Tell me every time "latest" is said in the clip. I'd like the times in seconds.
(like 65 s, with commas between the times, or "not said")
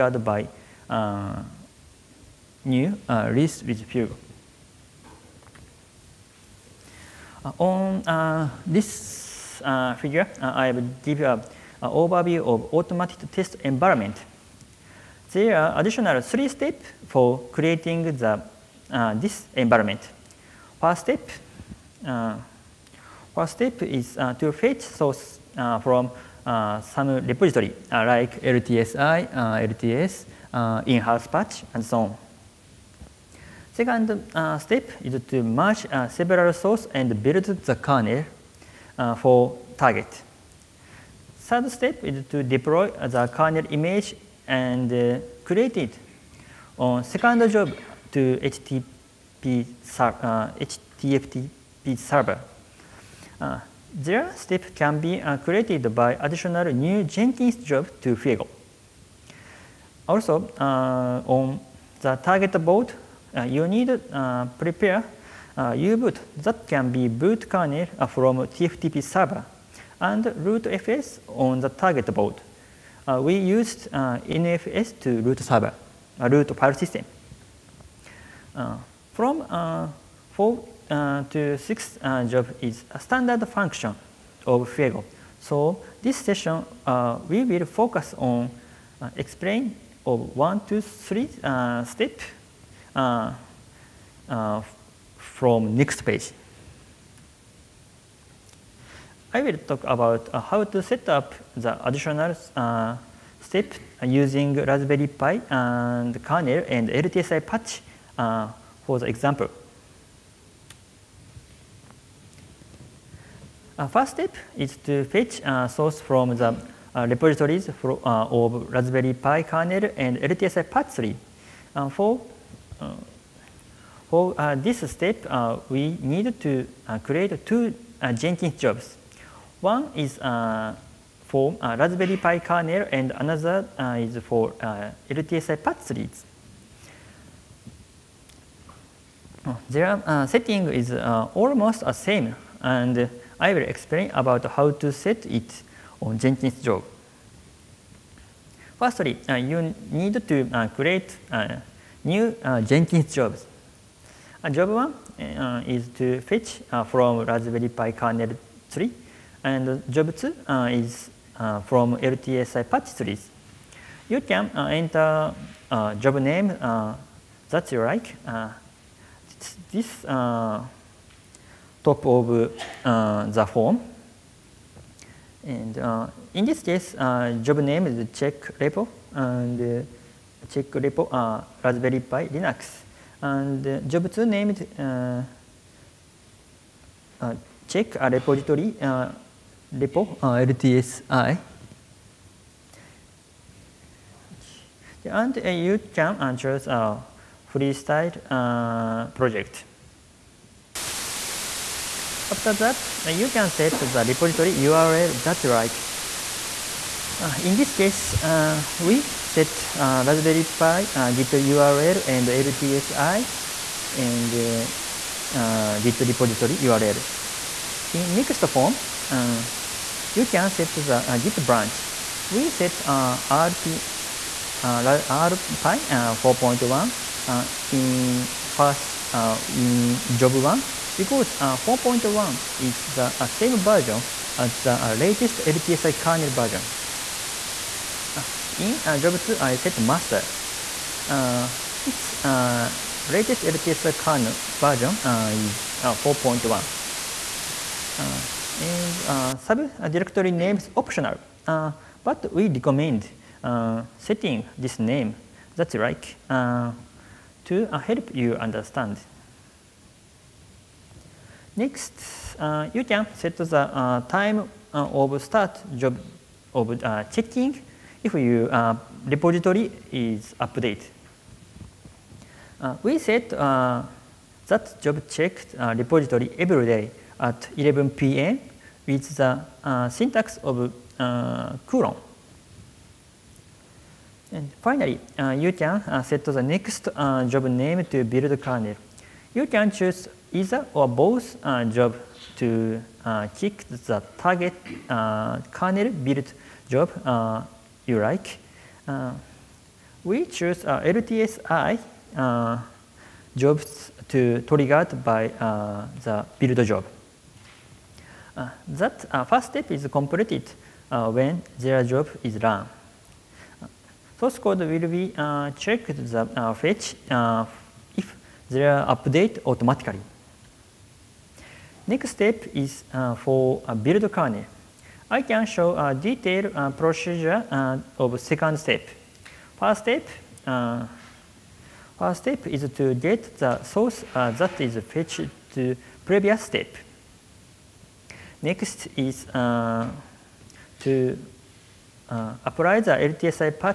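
234 s, 243 s.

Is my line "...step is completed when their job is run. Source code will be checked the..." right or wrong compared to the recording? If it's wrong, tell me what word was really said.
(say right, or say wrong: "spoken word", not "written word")
right.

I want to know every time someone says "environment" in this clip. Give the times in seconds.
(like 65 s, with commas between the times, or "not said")
13 s, 19 s.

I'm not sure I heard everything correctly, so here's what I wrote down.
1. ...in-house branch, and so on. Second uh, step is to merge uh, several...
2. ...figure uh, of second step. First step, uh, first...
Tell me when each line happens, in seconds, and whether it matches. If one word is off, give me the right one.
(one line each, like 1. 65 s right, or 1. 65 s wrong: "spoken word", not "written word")
1. 30 s wrong: "patch", not "branch"
2. 326 s wrong: "procedure", not "figure".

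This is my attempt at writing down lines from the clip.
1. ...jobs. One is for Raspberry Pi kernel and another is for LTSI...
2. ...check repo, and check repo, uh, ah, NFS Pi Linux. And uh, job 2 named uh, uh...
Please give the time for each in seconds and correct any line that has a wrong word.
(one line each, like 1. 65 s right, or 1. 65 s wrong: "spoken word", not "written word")
1. 128 s right
2. 178 s wrong: "Raspberry", not "NFS".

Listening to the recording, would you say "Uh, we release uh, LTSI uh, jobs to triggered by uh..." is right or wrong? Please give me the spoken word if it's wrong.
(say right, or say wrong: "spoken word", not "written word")
wrong: "choose", not "release".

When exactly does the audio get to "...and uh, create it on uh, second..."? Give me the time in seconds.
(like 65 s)
44 s.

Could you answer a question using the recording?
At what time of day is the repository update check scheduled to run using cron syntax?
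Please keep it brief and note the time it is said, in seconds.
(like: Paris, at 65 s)
11 p.m., at 277 s.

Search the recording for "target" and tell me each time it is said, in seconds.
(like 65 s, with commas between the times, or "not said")
39 s, 62 s, 71 s, 294 s.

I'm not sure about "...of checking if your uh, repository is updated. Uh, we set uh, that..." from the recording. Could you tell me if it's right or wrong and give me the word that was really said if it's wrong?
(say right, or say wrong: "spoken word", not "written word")
right.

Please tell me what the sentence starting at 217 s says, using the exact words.
In next form, you can set the Git branch.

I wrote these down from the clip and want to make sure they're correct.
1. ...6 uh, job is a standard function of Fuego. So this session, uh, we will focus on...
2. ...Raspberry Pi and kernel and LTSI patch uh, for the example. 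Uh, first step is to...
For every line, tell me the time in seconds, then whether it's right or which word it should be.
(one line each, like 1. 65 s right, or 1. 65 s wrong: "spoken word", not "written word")
1. 81 s right
2. 104 s right.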